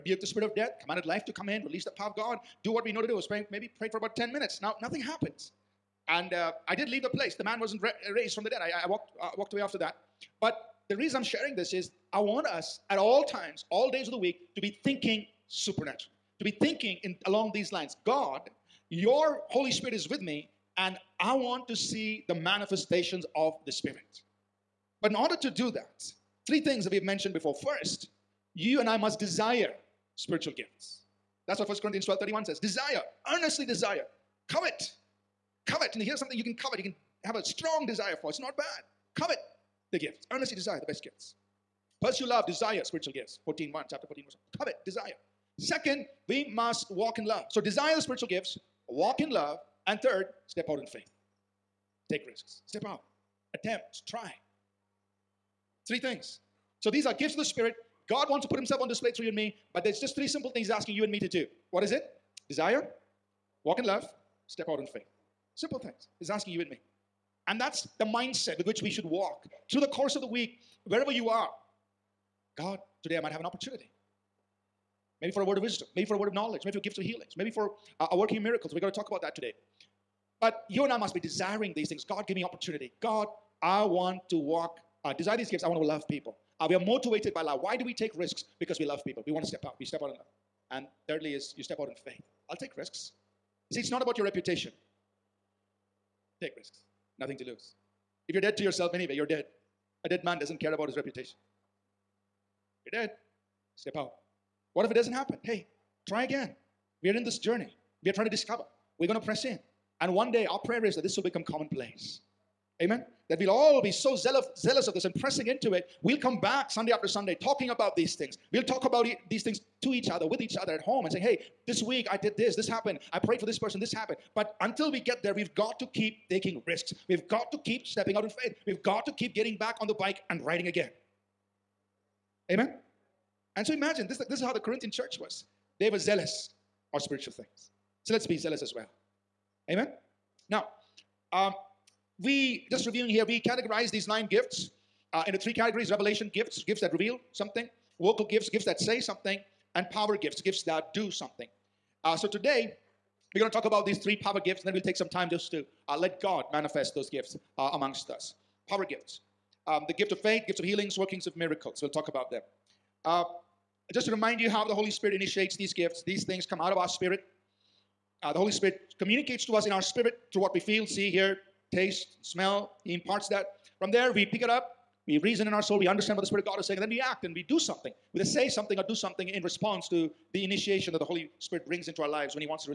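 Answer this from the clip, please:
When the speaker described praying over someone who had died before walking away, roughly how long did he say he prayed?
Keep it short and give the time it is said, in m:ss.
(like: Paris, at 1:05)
10 minutes, at 0:04.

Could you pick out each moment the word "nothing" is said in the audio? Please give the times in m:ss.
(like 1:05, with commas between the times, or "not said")
0:04, 1:37.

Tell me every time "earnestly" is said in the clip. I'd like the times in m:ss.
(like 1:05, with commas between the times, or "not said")
0:33, 0:40.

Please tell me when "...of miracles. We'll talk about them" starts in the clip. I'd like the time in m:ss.
2:41.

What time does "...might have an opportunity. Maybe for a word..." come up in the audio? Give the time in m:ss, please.
1:13.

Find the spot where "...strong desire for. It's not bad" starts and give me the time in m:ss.
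0:37.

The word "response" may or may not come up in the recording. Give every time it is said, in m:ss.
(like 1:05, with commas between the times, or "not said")
2:59.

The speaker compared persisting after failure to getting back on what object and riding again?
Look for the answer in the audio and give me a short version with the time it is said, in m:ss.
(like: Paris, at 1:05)
bike, at 2:09.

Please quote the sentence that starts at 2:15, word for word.
They were zealous on spiritual things.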